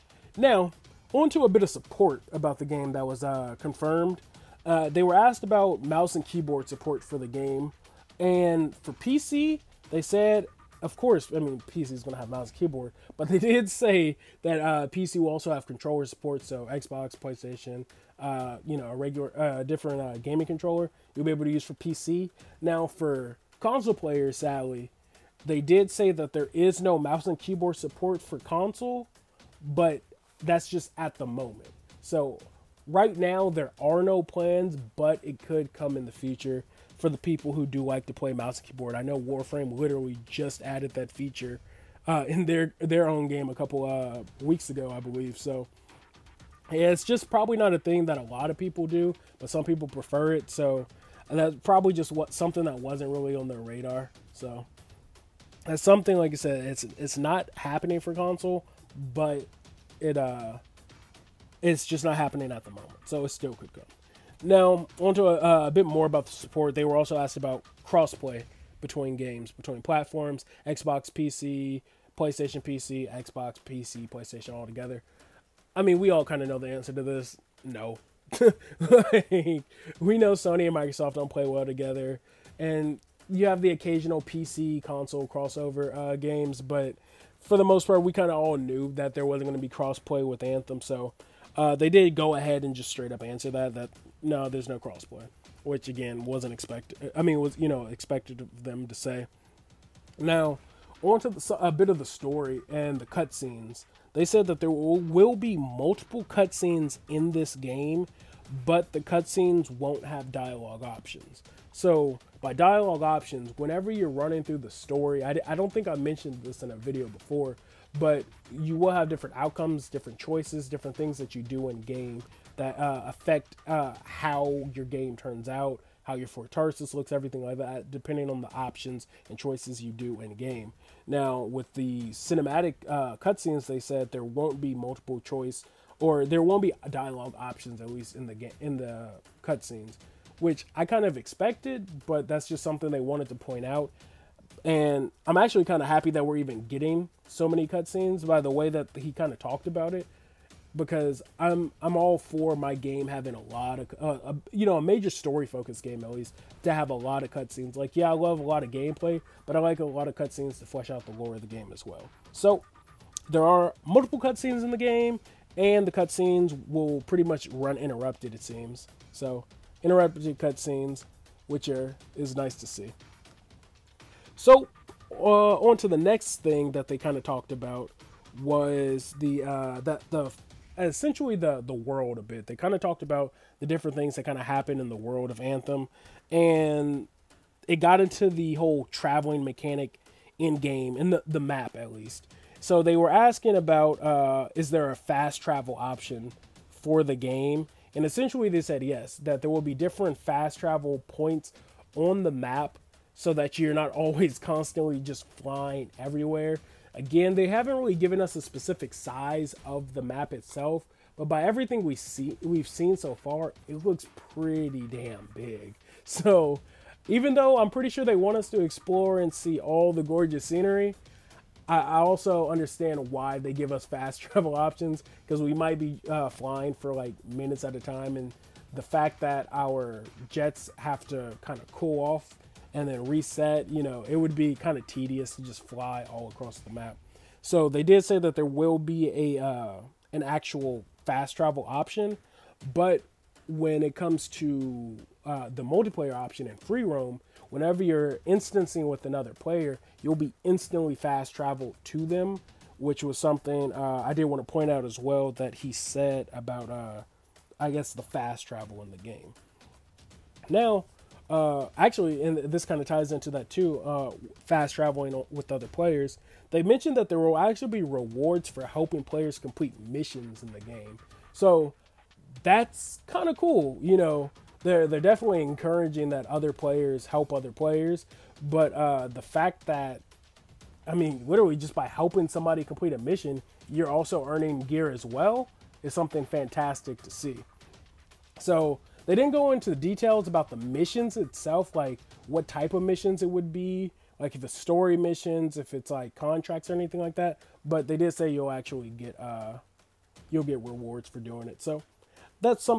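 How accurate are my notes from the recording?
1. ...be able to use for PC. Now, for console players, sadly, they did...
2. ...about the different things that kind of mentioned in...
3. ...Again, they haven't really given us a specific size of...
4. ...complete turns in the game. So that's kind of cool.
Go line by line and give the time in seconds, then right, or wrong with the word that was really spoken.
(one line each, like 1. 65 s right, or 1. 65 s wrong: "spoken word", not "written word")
1. 21 s right
2. 183 s wrong: "happened", not "mentioned"
3. 206 s right
4. 269 s wrong: "missions", not "turns".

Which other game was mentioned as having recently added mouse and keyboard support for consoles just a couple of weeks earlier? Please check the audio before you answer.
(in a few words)
Warframe.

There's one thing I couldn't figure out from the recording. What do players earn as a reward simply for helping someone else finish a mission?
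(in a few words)
Gear.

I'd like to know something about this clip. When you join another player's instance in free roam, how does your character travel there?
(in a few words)
Instantly fast traveled.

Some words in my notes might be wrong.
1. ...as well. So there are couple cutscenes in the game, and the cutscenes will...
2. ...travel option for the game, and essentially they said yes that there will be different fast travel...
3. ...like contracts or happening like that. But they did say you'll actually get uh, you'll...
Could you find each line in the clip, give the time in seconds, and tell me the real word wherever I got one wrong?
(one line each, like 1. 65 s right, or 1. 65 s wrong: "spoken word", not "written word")
1. 161 s wrong: "multiple", not "couple"
2. 195 s right
3. 295 s wrong: "anything", not "happening".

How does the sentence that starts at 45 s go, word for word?
So yeah, it's just probably not a thing that a lot of people do, but some people prefer it.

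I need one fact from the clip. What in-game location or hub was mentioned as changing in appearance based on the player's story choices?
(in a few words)
Tarsis.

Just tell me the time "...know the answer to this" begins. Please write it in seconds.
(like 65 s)
76 s.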